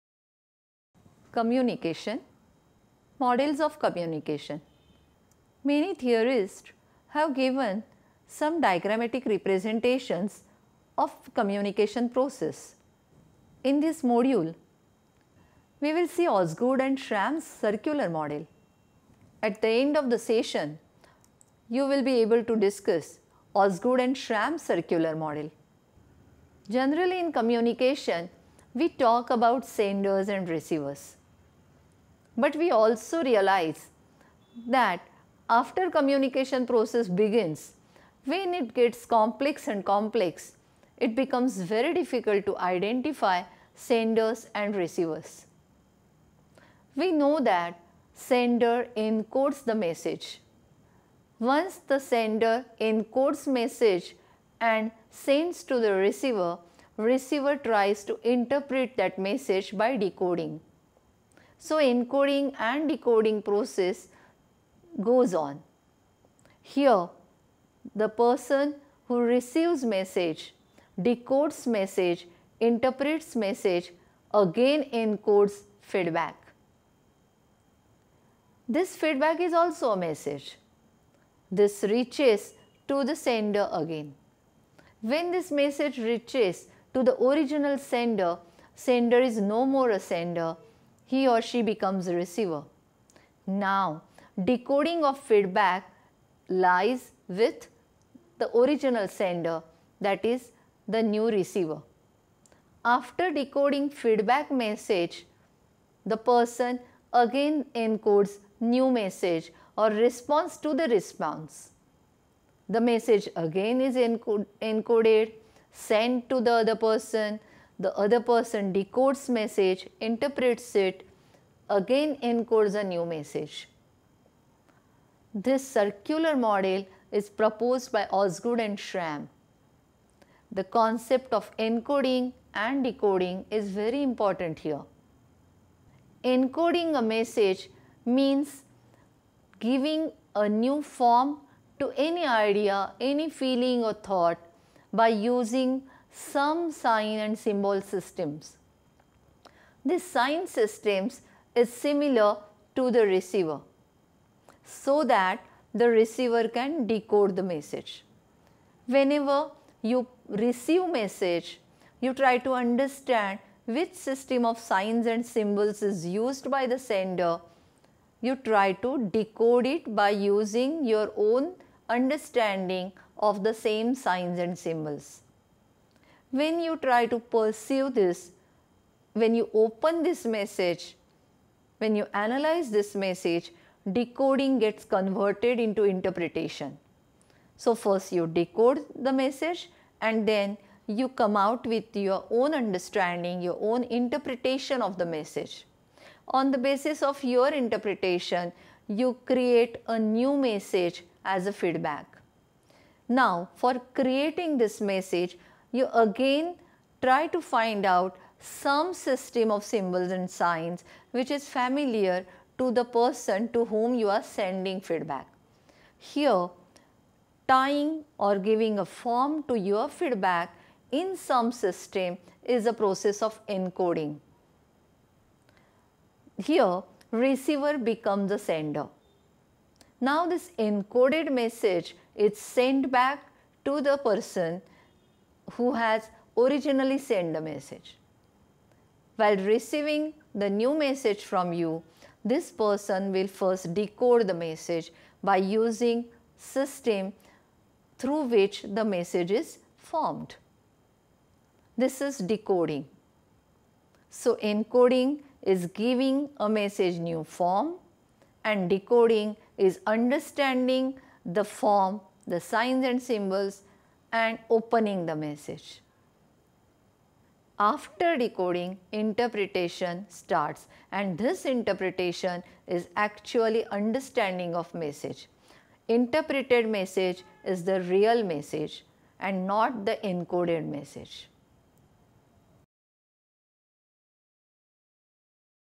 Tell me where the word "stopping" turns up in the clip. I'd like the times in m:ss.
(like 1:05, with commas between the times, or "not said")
not said.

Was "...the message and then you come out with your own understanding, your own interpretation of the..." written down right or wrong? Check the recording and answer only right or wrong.
right.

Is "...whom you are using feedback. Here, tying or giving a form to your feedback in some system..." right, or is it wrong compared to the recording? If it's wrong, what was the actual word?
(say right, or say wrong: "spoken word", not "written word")
wrong: "sending", not "using".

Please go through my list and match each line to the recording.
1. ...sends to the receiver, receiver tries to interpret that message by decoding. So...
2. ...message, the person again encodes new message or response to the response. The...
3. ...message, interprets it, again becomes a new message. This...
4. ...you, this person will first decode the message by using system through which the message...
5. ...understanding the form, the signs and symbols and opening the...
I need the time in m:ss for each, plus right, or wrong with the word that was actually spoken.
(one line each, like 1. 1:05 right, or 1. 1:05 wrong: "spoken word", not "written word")
1. 0:55 right
2. 1:44 right
3. 1:59 wrong: "encodes", not "becomes"
4. 4:01 right
5. 4:19 right.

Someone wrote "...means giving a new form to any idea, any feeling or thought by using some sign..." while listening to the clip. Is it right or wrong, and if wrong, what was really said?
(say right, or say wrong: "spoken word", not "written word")
right.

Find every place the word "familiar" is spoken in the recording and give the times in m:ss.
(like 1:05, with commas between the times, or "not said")
3:31.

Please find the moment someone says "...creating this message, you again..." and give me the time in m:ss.
3:23.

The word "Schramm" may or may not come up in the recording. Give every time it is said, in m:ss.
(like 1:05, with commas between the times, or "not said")
0:16, 0:24, 2:08.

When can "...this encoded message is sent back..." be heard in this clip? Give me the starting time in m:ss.
3:50.